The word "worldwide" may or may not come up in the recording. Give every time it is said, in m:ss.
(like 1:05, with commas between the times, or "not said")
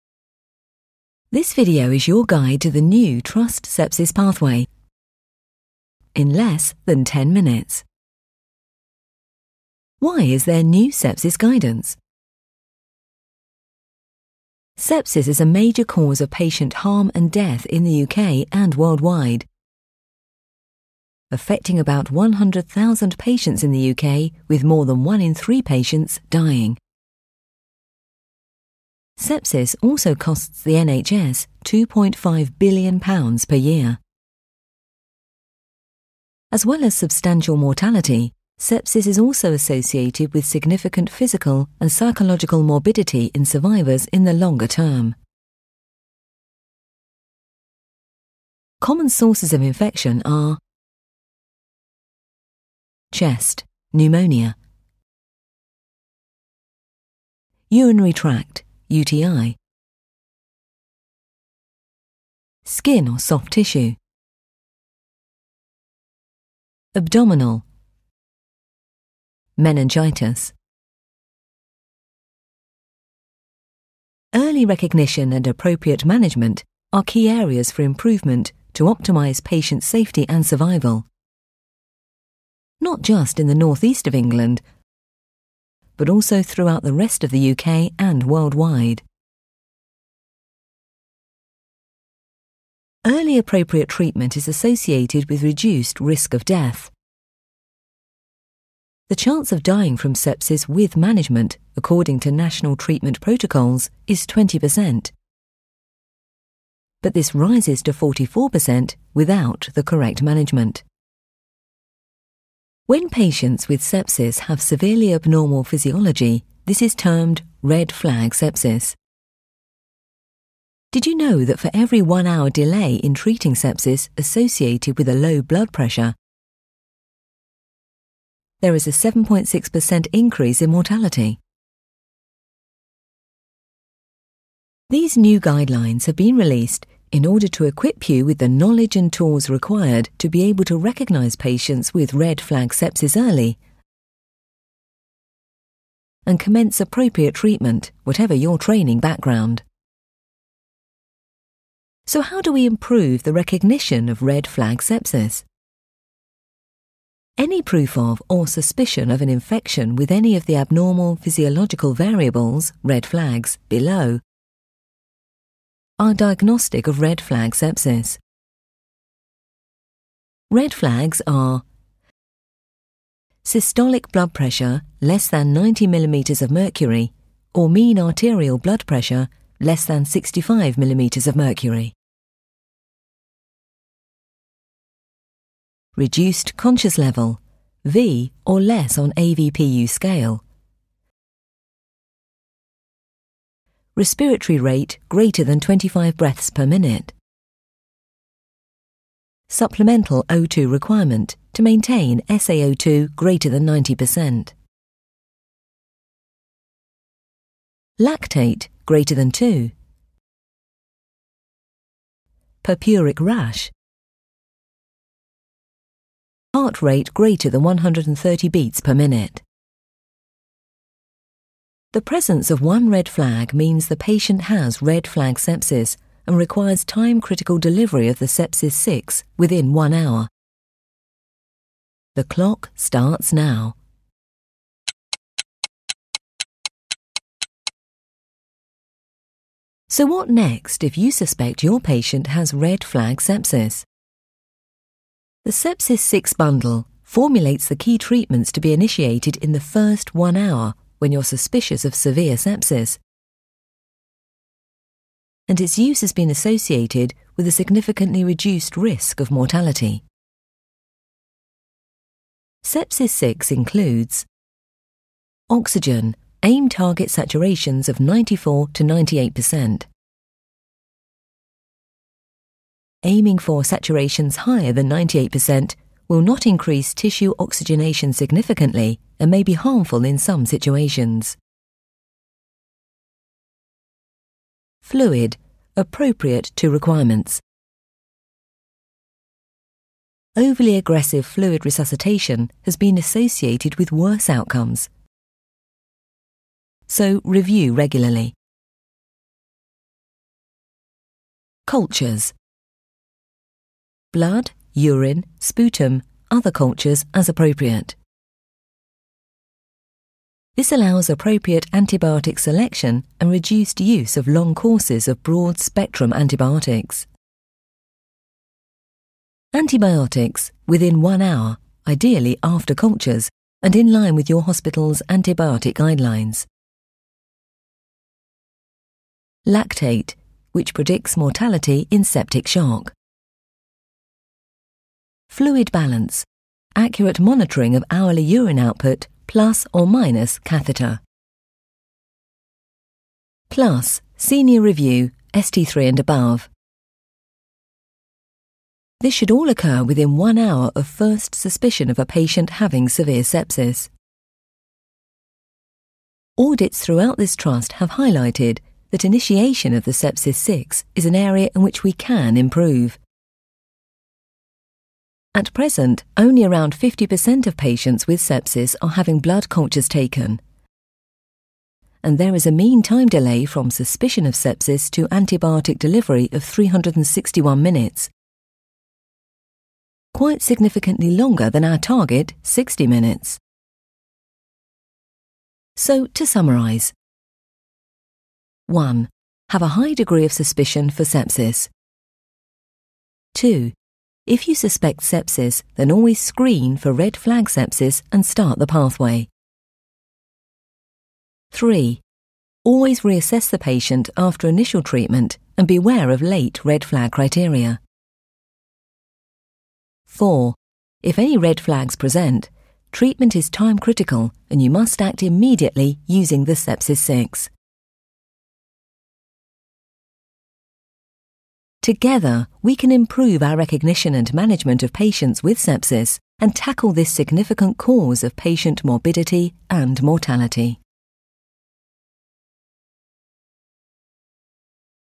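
0:18, 1:28.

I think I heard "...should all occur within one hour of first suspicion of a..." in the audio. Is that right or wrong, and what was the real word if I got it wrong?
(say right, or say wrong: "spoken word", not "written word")
right.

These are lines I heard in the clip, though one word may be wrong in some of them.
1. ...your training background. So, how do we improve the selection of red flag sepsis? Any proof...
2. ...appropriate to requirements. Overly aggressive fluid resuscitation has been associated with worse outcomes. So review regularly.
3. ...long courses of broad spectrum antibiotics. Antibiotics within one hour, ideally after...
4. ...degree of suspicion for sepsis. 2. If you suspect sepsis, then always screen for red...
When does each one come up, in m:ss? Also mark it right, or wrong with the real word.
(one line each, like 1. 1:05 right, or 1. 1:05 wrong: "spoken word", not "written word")
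1. 2:28 wrong: "recognition", not "selection"
2. 4:45 right
3. 5:14 right
4. 6:29 right.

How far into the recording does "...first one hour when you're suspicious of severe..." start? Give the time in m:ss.
4:09.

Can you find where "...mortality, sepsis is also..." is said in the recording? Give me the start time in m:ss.
0:37.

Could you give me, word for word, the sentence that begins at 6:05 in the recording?
At present, only around 50% of patients with sepsis are having blood cultures taken.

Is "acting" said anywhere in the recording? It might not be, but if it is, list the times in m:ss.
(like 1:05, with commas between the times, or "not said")
not said.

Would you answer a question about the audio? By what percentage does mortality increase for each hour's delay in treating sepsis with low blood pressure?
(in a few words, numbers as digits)
7.6%.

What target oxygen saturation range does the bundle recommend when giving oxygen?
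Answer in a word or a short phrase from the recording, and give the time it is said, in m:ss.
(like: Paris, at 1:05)
94 to 98%, at 4:27.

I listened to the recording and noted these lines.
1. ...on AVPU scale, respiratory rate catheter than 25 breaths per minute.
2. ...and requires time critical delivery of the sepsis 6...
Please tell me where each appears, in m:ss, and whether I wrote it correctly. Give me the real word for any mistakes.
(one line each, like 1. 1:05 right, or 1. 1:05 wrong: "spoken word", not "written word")
1. 3:08 wrong: "greater", not "catheter"
2. 3:46 right.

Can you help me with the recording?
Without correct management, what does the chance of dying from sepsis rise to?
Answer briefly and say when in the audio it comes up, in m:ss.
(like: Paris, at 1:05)
44%, at 1:47.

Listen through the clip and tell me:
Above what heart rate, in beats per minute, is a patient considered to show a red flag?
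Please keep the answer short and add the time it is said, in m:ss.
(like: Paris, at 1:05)
130, at 3:37.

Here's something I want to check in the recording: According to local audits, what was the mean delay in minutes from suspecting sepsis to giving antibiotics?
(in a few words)
361 minutes.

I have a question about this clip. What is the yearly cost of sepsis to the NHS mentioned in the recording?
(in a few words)
£2.5 billion.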